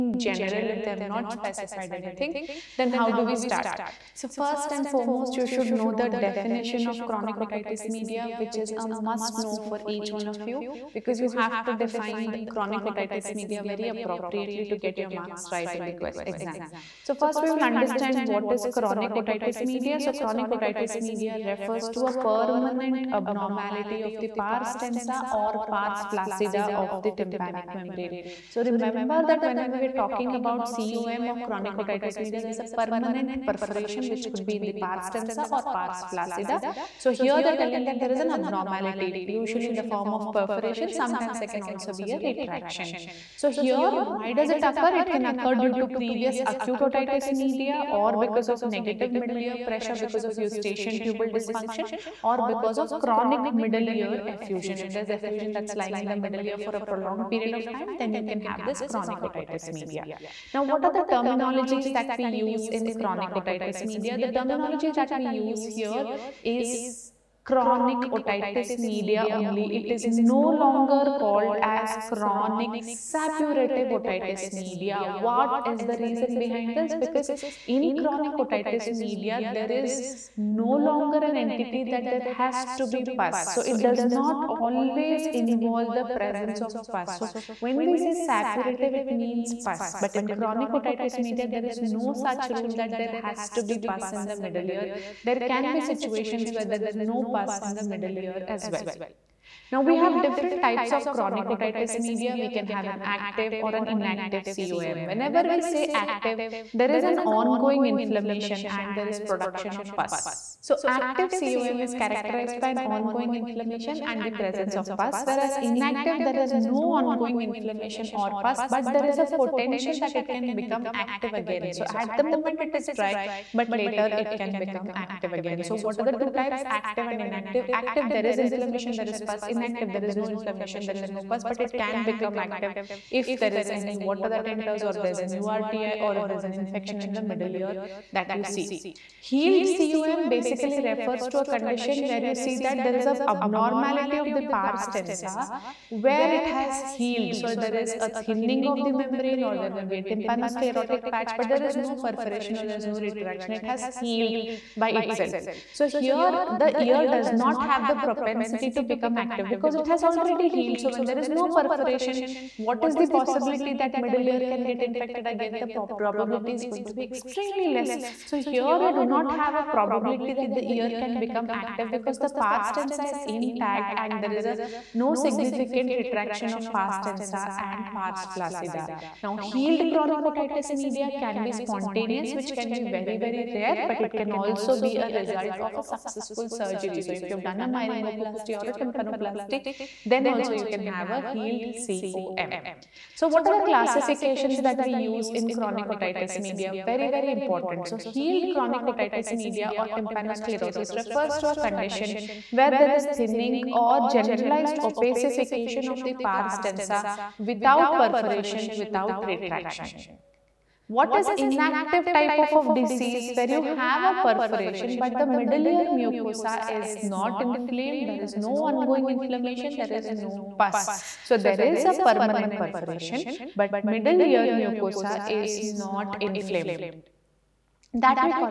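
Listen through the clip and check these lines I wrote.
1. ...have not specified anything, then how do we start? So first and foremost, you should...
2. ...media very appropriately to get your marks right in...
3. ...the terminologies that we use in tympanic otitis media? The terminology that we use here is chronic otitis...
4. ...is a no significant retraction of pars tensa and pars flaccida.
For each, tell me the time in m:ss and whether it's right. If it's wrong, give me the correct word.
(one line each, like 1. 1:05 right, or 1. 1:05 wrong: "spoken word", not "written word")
1. 0:00 right
2. 0:13 right
3. 1:00 wrong: "chronic", not "tympanic"
4. 2:54 right.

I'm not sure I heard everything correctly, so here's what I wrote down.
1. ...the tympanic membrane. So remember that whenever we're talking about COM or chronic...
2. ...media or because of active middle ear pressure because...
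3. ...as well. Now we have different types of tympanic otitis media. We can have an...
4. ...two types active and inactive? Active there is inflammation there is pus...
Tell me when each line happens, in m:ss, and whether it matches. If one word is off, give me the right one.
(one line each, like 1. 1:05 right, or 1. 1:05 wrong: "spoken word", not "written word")
1. 0:27 right
2. 0:47 wrong: "negative", not "active"
3. 1:38 wrong: "chronic", not "tympanic"
4. 2:06 right.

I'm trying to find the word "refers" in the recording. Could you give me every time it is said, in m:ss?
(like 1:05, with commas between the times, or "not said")
0:21, 2:20, 3:20.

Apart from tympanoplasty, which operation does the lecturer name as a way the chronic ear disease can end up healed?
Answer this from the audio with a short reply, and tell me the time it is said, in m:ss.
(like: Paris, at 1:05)
Myringoplasty, at 3:07.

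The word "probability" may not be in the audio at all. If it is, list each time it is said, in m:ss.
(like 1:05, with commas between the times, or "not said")
2:45, 2:49.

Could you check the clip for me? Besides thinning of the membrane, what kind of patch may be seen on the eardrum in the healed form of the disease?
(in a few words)
Tympanosclerotic patch.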